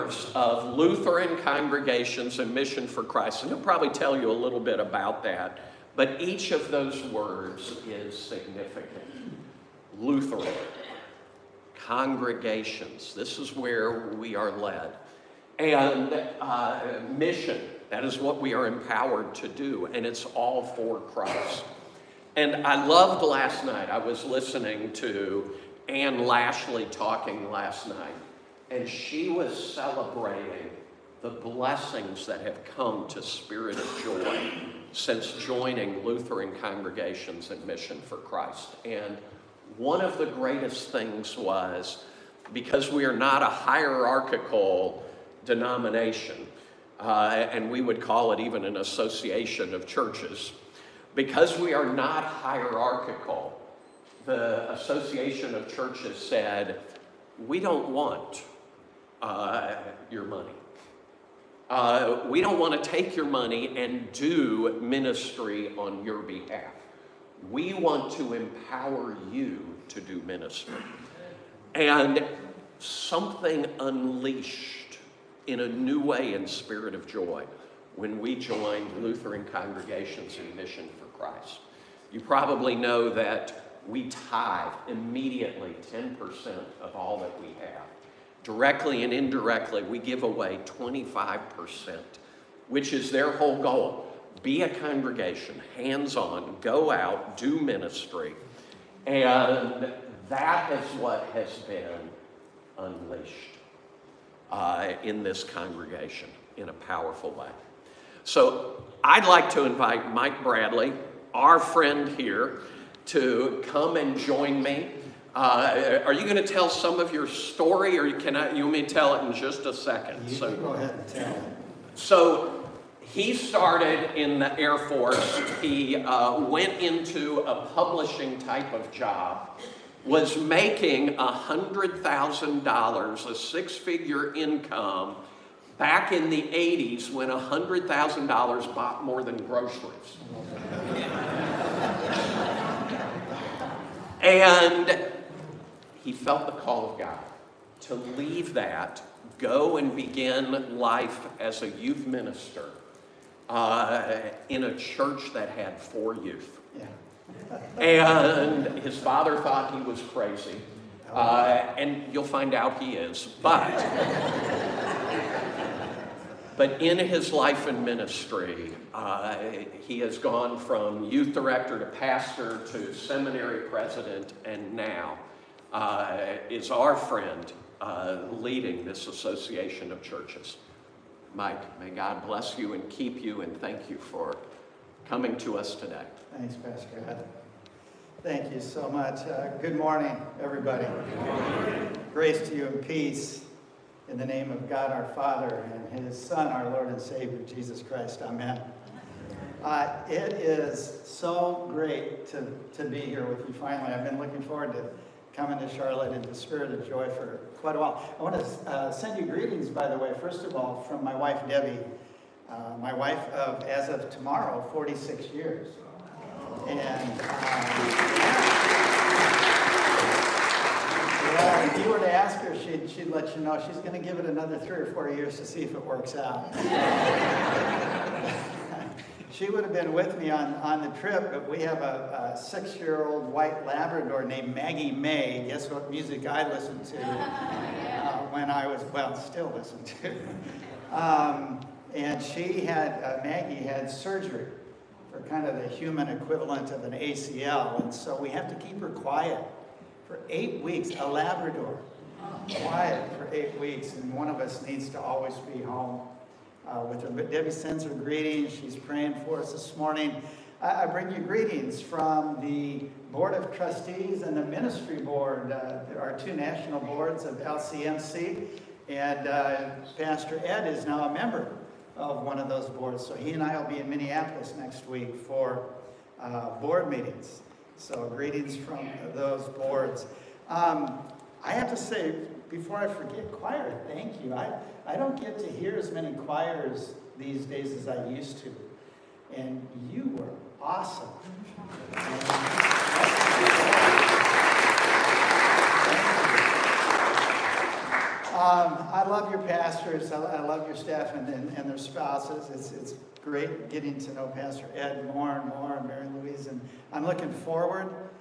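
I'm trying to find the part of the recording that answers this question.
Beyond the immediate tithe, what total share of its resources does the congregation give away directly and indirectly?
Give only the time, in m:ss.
1:30.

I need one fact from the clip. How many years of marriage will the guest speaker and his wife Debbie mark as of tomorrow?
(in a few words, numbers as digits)
46.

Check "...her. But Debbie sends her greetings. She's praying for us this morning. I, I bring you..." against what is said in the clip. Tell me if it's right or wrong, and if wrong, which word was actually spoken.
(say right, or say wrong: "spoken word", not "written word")
right.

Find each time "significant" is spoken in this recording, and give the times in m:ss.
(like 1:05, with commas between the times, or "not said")
0:08.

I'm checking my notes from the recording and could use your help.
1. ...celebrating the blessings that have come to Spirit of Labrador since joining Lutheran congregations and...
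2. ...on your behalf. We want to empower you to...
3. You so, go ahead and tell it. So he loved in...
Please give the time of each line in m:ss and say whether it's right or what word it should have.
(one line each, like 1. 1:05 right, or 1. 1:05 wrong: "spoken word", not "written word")
1. 0:29 wrong: "Joy", not "Labrador"
2. 1:05 right
3. 2:00 wrong: "started", not "loved".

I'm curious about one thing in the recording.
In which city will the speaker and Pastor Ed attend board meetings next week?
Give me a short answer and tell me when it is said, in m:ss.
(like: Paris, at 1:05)
Minneapolis, at 4:33.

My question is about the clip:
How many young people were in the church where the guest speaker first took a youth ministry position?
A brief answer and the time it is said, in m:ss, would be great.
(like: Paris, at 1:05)
4, at 2:35.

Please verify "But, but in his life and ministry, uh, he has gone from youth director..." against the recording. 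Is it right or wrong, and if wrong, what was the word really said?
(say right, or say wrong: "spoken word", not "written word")
right.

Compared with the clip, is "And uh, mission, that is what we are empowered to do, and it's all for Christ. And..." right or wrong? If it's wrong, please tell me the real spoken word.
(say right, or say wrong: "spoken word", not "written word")
right.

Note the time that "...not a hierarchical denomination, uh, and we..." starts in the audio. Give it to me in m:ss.
0:43.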